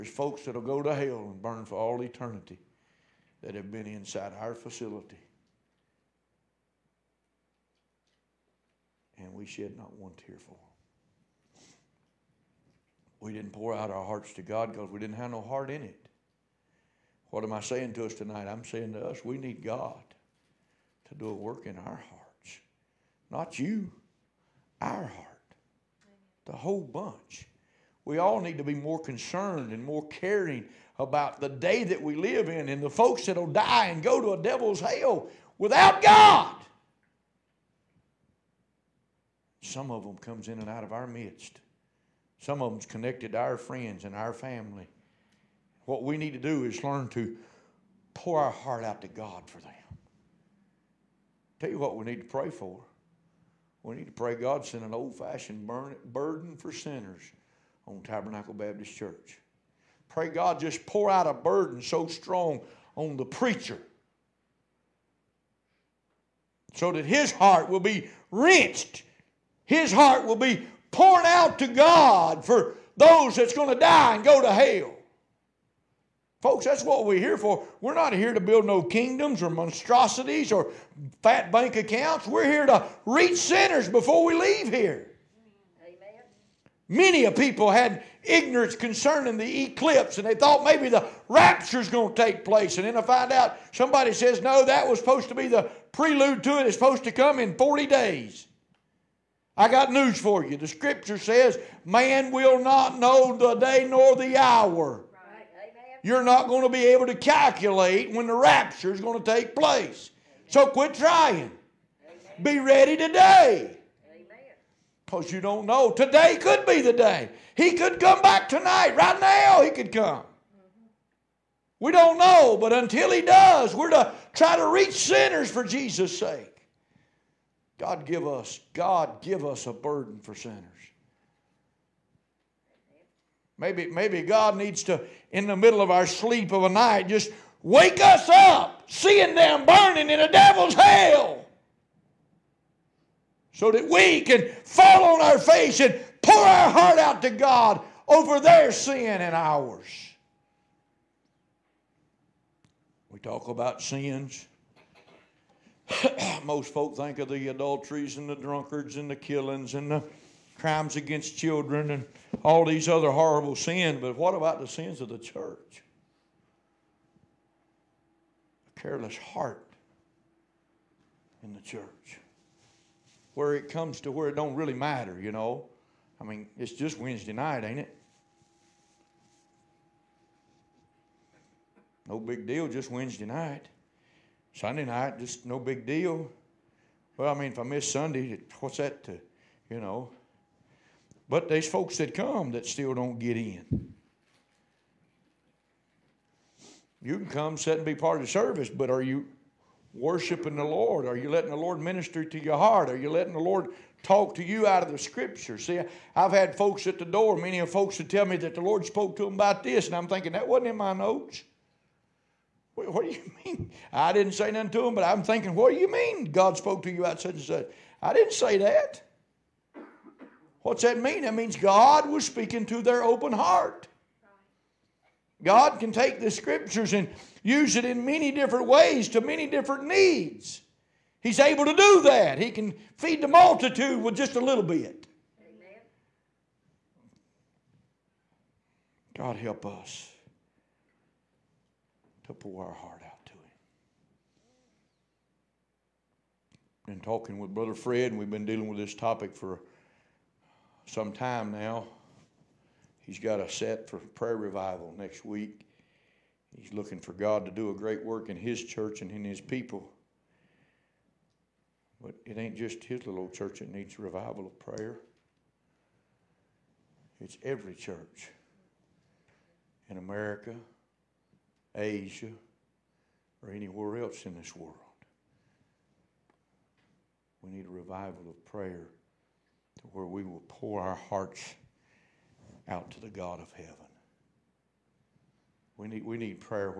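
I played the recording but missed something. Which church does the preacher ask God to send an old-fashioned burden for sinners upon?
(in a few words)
Tabernacle Baptist Church.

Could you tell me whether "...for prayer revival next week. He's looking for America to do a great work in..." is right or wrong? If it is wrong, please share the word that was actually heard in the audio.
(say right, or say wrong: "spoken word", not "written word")
wrong: "God", not "America".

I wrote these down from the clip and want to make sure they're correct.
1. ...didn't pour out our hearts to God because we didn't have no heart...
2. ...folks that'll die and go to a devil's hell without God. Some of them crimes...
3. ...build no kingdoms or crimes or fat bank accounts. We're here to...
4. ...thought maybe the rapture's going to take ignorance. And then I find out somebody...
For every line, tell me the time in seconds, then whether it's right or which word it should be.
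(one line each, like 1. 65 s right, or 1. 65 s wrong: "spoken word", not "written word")
1. 13 s right
2. 32 s wrong: "comes", not "crimes"
3. 78 s wrong: "monstrosities", not "crimes"
4. 90 s wrong: "place", not "ignorance".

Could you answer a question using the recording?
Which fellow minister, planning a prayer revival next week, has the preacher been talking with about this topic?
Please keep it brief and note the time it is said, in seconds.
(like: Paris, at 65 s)
Brother Fred, at 247 s.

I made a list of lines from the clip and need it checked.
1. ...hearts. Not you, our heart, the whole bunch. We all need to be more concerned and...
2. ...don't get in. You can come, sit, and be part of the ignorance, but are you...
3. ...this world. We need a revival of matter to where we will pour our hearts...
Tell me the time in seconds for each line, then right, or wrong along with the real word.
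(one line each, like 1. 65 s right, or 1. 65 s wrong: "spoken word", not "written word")
1. 22 s right
2. 192 s wrong: "service", not "ignorance"
3. 274 s wrong: "prayer", not "matter".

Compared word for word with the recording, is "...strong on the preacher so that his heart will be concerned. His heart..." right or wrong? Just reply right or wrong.
wrong.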